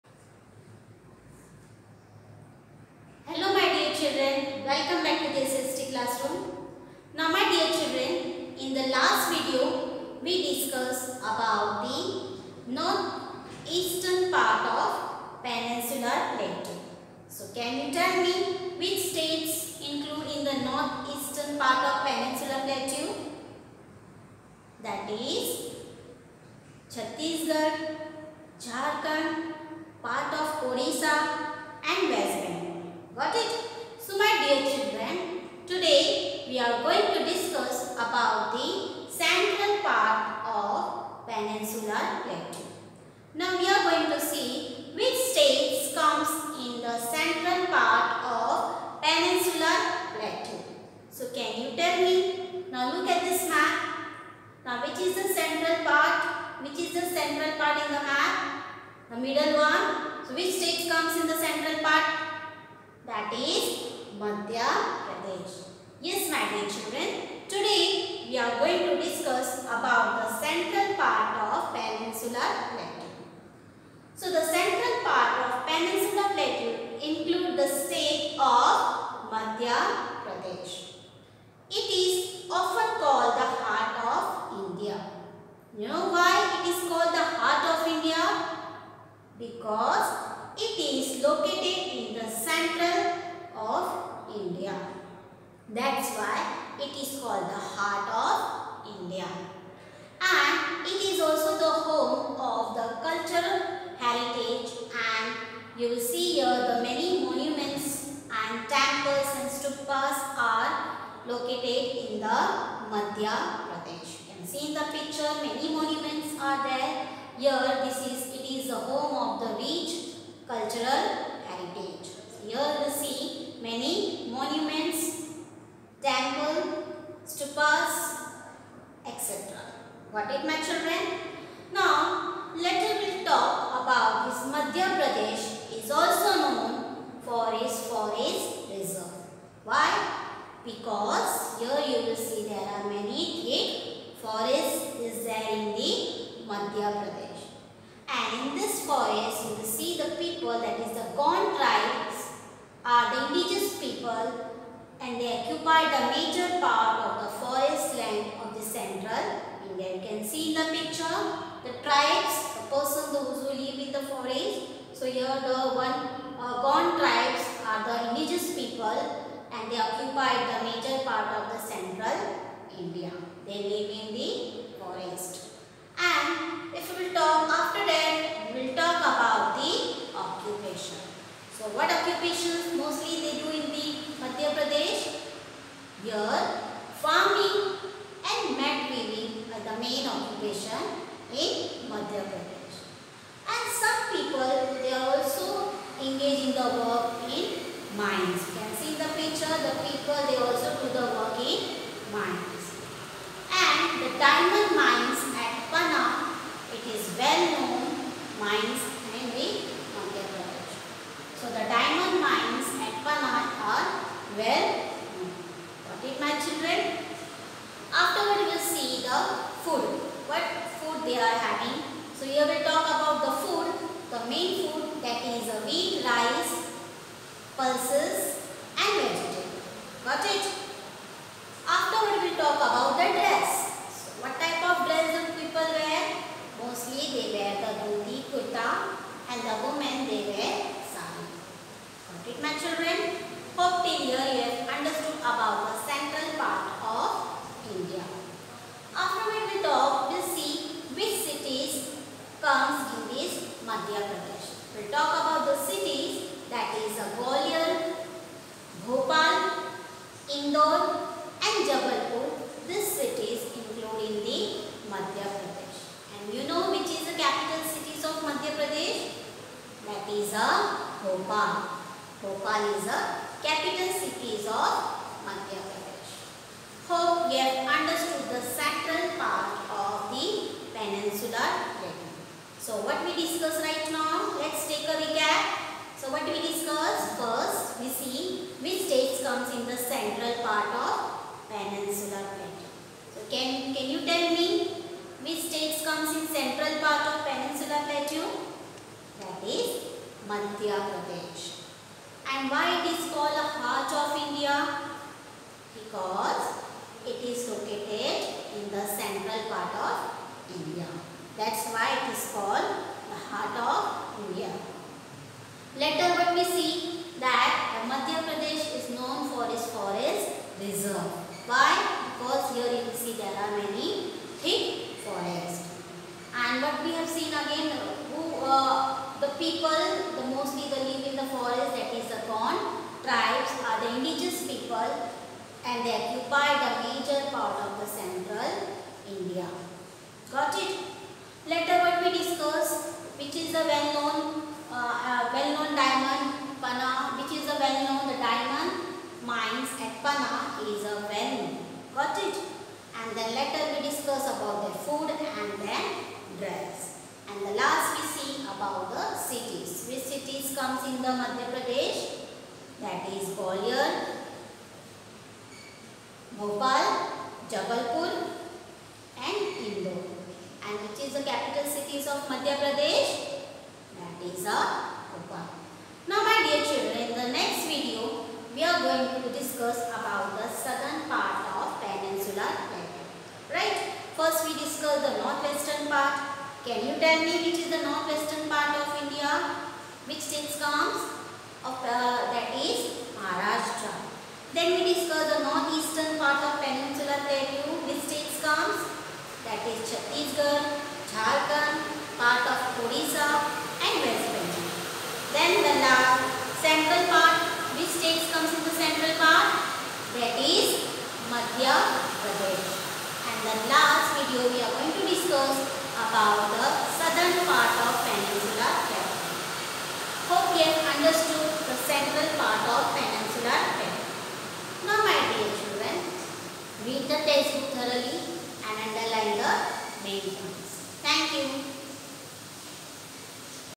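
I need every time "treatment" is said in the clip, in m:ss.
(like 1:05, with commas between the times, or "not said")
not said.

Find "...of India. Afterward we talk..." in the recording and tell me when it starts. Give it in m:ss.
4:06.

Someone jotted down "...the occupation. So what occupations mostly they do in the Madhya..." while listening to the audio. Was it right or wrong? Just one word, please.
right.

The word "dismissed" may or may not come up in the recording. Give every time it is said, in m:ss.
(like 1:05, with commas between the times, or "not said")
not said.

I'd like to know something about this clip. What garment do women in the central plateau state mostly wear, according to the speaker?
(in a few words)
Sari.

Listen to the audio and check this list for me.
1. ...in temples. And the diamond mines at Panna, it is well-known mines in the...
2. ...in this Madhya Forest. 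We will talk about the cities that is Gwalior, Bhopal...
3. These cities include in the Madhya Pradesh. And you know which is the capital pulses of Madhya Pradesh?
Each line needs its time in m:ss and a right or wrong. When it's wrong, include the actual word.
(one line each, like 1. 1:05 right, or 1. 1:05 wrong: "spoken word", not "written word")
1. 3:21 wrong: "mines", not "temples"
2. 4:12 wrong: "Pradesh", not "Forest"
3. 4:22 wrong: "cities", not "pulses".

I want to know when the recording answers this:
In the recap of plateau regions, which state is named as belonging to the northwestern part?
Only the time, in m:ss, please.
6:33.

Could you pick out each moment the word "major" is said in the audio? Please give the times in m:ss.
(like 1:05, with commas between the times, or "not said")
2:36, 2:50, 5:36.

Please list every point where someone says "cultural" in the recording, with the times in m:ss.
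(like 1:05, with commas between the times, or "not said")
1:42, 2:00.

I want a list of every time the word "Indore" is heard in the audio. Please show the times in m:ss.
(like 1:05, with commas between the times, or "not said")
4:20, 6:09.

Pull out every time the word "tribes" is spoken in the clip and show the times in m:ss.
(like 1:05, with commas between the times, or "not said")
2:31, 2:41, 2:46, 5:33.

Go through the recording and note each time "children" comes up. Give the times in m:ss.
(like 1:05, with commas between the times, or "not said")
0:07, 0:34, 1:06, 3:36, 4:02, 6:16, 7:05.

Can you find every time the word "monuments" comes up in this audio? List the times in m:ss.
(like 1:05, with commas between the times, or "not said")
1:47, 1:55.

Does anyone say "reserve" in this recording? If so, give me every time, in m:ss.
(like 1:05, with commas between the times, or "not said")
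2:18, 5:20.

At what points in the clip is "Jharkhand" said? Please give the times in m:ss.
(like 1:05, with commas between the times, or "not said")
0:28, 6:41.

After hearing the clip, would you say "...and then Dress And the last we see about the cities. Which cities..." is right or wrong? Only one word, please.
right.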